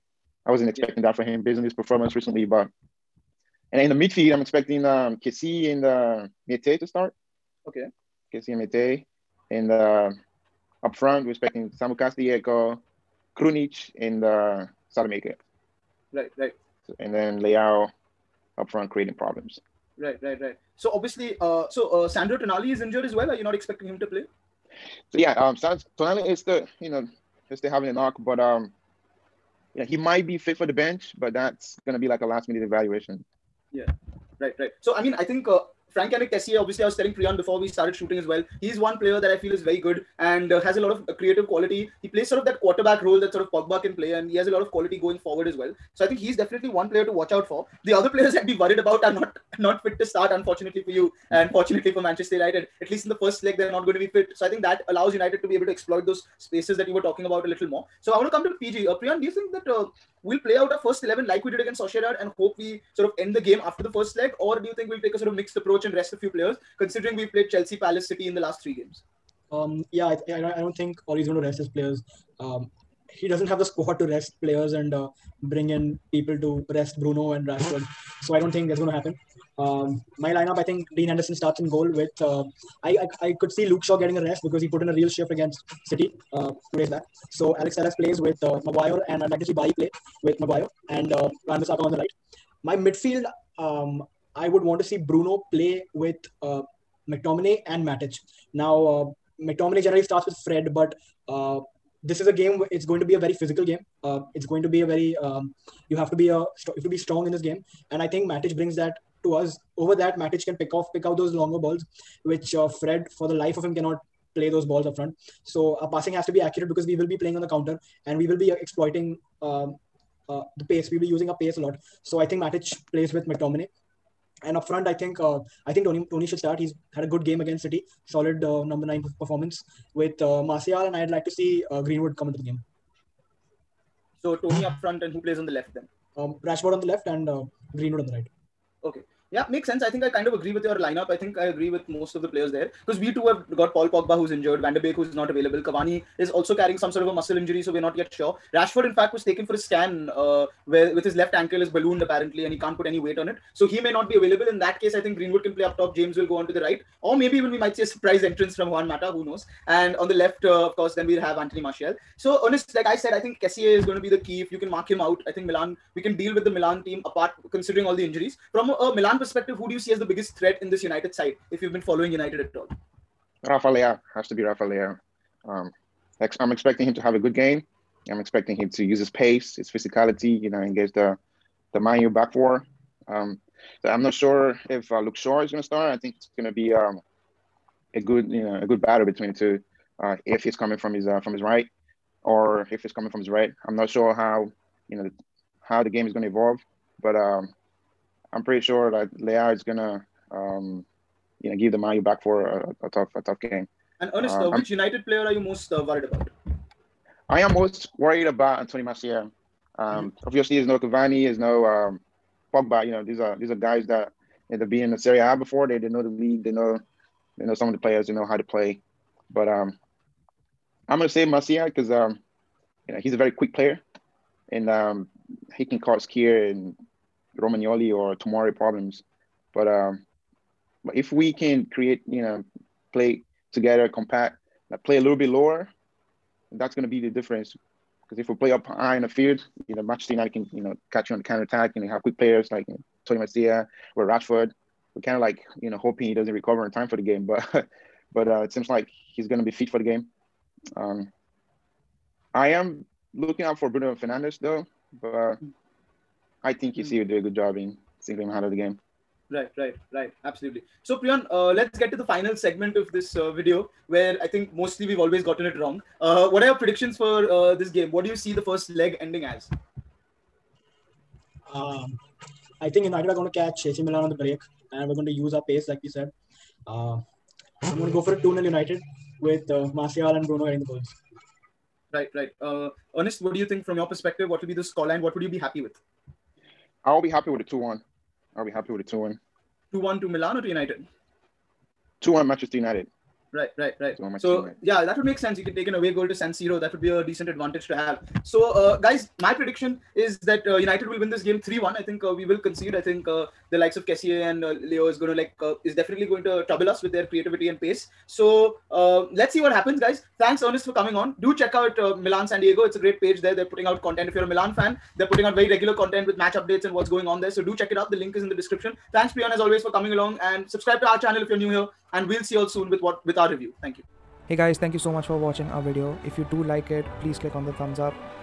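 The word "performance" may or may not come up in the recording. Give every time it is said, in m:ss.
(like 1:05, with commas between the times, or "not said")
0:01, 2:09.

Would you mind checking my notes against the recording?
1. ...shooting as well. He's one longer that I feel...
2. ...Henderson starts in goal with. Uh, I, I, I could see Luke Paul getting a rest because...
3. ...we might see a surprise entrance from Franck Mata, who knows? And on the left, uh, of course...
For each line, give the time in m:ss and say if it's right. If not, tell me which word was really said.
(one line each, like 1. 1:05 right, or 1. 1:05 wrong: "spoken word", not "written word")
1. 0:37 wrong: "player", not "longer"
2. 1:21 wrong: "Shaw", not "Paul"
3. 2:37 wrong: "Juan", not "Franck".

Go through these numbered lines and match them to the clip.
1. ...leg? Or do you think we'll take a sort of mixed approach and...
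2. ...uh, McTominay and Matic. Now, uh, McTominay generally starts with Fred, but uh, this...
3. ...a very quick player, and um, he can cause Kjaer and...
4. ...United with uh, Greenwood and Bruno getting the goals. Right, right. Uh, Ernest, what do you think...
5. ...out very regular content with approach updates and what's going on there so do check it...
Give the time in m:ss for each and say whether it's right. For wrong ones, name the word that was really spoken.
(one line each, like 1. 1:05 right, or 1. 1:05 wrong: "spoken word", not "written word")
1. 1:04 right
2. 1:36 right
3. 3:43 right
4. 4:38 wrong: "Martial", not "Greenwood"
5. 5:15 wrong: "match", not "approach".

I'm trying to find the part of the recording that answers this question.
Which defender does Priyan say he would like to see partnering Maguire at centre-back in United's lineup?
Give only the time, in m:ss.
1:29.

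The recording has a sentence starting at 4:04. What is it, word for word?
We're kind of like, you know, hoping he doesn't recover in time for the game.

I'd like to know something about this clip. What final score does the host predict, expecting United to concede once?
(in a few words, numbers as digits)
3-1.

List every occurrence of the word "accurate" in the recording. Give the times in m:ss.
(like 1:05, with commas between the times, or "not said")
1:56.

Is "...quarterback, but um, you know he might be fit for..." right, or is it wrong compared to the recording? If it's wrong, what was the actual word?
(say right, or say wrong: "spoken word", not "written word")
wrong: "knock", not "quarterback".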